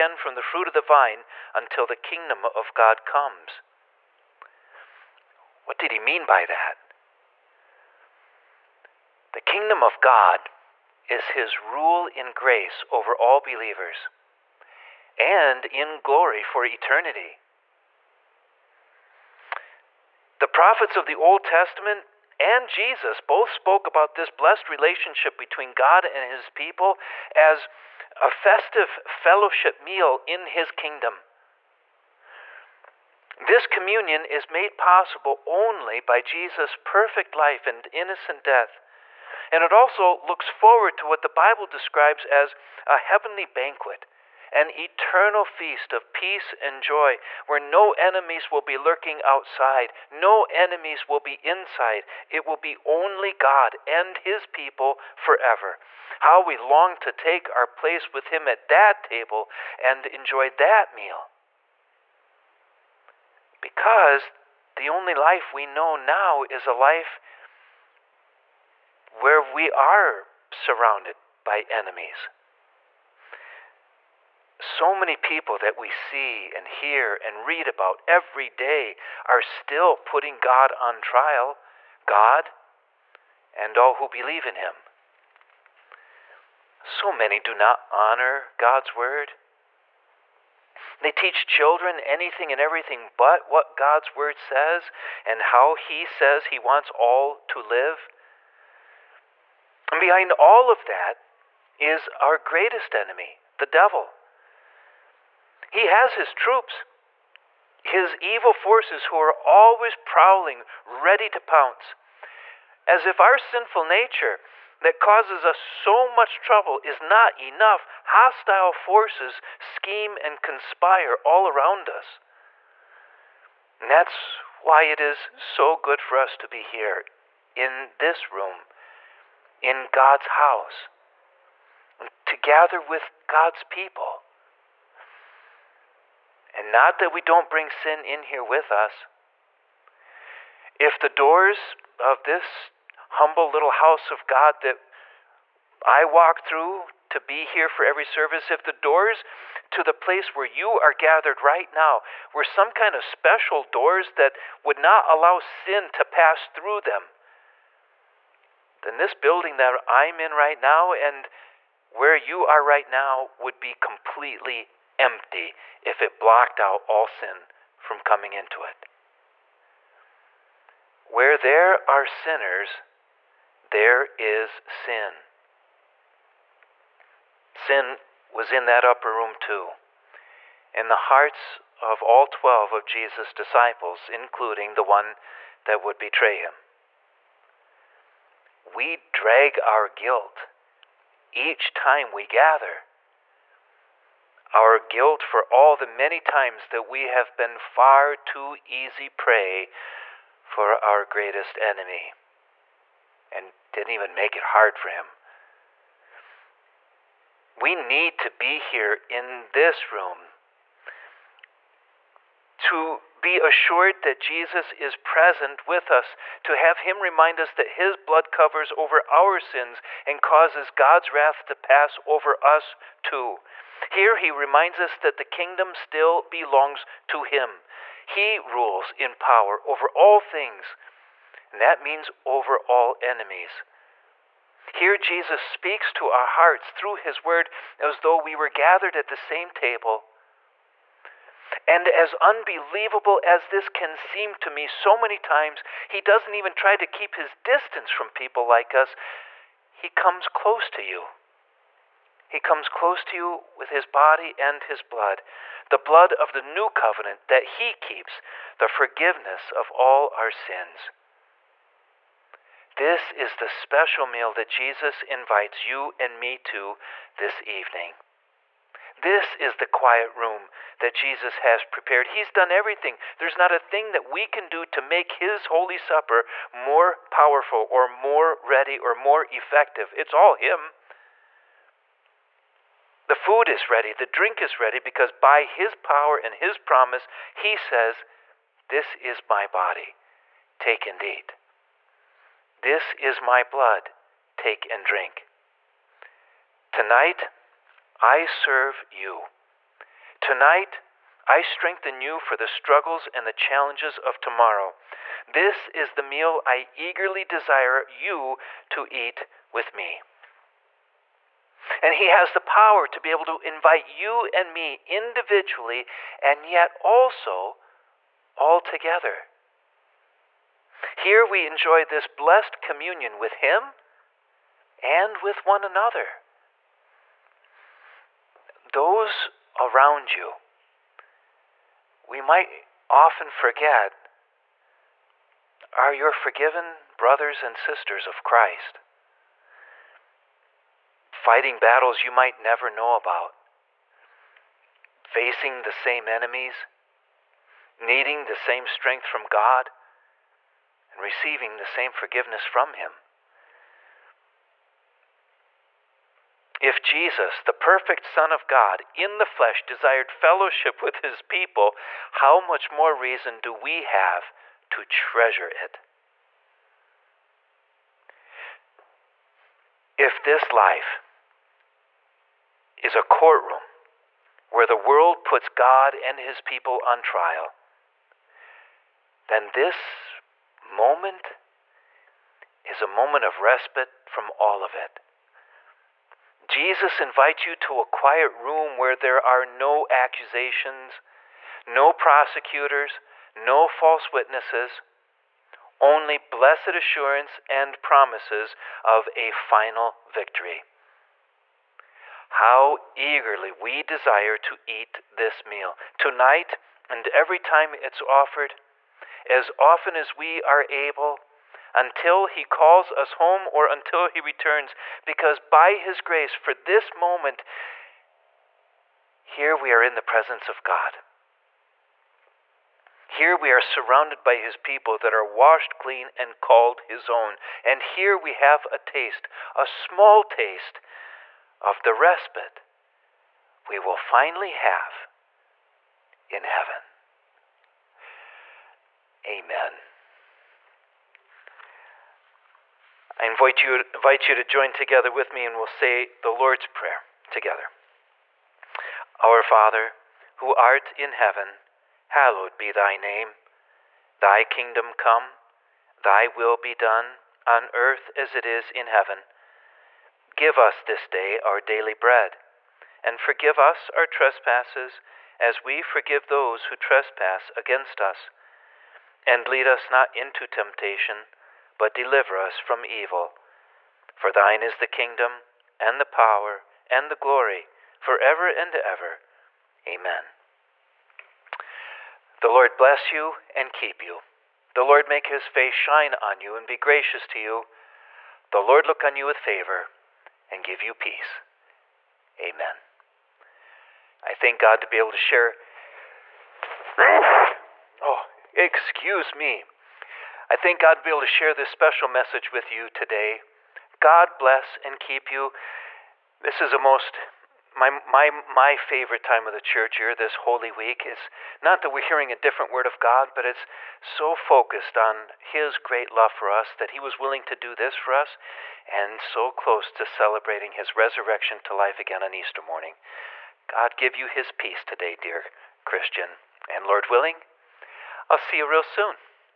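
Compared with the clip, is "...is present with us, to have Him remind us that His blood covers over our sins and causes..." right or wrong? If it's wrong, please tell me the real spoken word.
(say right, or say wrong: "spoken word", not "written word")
right.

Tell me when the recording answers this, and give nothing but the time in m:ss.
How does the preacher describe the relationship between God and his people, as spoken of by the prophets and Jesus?
0:28.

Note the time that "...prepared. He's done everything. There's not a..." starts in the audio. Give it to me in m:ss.
4:31.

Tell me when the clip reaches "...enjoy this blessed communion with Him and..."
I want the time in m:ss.
5:21.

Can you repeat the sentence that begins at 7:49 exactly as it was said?
And lead us not into temptation but deliver us from evil.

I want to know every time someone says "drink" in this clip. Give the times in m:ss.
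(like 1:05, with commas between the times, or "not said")
4:44, 4:54.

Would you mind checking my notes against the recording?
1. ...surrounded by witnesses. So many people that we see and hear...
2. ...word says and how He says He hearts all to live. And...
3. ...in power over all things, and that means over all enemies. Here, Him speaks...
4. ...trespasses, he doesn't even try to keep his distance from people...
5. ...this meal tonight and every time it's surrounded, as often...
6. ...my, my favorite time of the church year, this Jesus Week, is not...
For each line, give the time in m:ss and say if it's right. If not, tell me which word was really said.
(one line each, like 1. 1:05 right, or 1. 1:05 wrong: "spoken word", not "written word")
1. 1:10 wrong: "enemies", not "witnesses"
2. 1:34 wrong: "wants", not "hearts"
3. 3:48 wrong: "Jesus", not "Him"
4. 4:05 wrong: "times", not "trespasses"
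5. 6:45 wrong: "offered", not "surrounded"
6. 8:27 wrong: "Holy", not "Jesus".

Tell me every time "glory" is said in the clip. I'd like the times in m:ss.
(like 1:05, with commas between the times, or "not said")
0:16, 7:57.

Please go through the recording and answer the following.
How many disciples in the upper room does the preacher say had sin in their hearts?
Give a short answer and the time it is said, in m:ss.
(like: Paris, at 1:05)
12, at 3:02.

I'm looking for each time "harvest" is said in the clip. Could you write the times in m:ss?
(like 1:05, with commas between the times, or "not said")
not said.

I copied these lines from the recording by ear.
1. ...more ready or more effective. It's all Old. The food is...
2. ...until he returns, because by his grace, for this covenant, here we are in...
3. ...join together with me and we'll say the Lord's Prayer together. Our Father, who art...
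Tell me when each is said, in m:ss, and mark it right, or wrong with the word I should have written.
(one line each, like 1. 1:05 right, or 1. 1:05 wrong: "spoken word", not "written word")
1. 4:37 wrong: "Him", not "Old"
2. 6:53 wrong: "moment", not "covenant"
3. 7:24 right.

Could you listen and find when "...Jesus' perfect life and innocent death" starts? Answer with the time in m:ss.
0:36.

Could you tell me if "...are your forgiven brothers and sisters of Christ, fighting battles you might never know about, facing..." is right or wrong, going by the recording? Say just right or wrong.
right.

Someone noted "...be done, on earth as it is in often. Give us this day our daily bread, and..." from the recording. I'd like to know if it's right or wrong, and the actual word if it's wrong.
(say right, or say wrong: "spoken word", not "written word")
wrong: "heaven", not "often".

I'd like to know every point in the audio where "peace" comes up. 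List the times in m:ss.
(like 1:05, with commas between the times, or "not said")
0:46, 8:10, 8:44.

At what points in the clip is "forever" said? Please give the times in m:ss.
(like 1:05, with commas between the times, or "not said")
0:55, 7:57.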